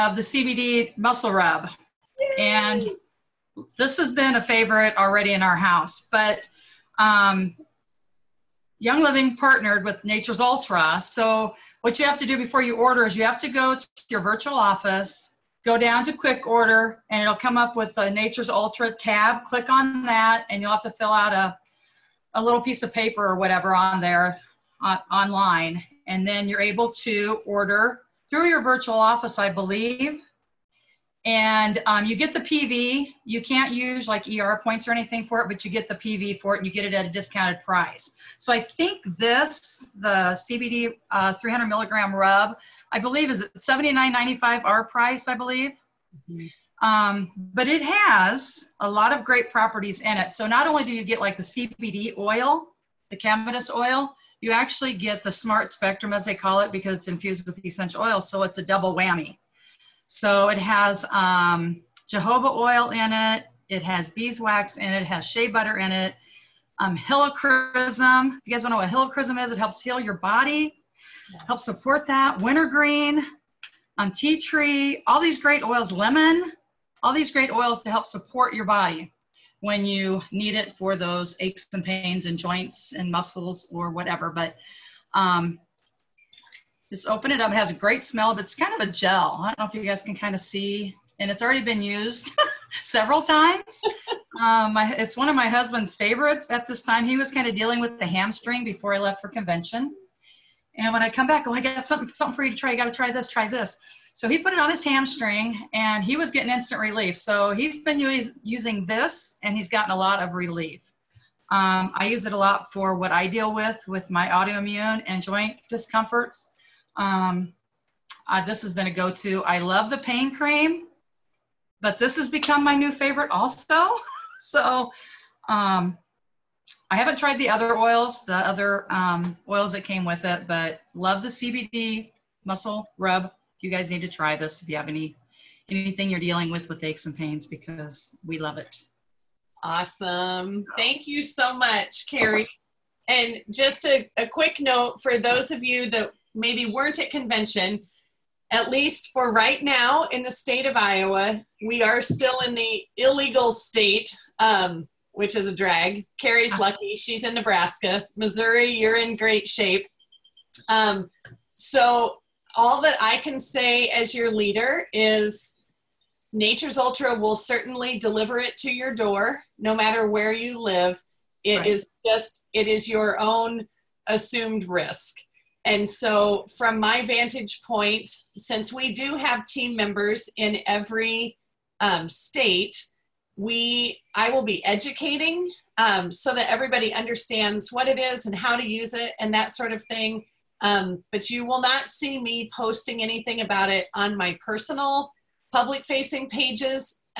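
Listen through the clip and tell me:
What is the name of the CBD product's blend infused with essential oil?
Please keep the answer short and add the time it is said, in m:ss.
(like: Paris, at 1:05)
smart spectrum, at 0:55.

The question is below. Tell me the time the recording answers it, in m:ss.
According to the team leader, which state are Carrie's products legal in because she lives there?
2:37.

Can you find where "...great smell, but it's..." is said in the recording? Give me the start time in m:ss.
1:27.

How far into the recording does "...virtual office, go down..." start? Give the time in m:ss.
0:14.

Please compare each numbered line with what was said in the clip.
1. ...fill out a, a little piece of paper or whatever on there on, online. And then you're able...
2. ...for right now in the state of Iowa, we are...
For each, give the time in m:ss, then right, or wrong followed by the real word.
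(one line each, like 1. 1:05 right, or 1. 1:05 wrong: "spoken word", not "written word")
1. 0:20 right
2. 2:29 right.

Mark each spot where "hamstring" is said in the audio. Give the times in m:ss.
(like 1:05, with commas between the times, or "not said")
1:38, 1:44.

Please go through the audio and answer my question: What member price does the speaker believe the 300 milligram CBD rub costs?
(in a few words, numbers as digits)
$79.95.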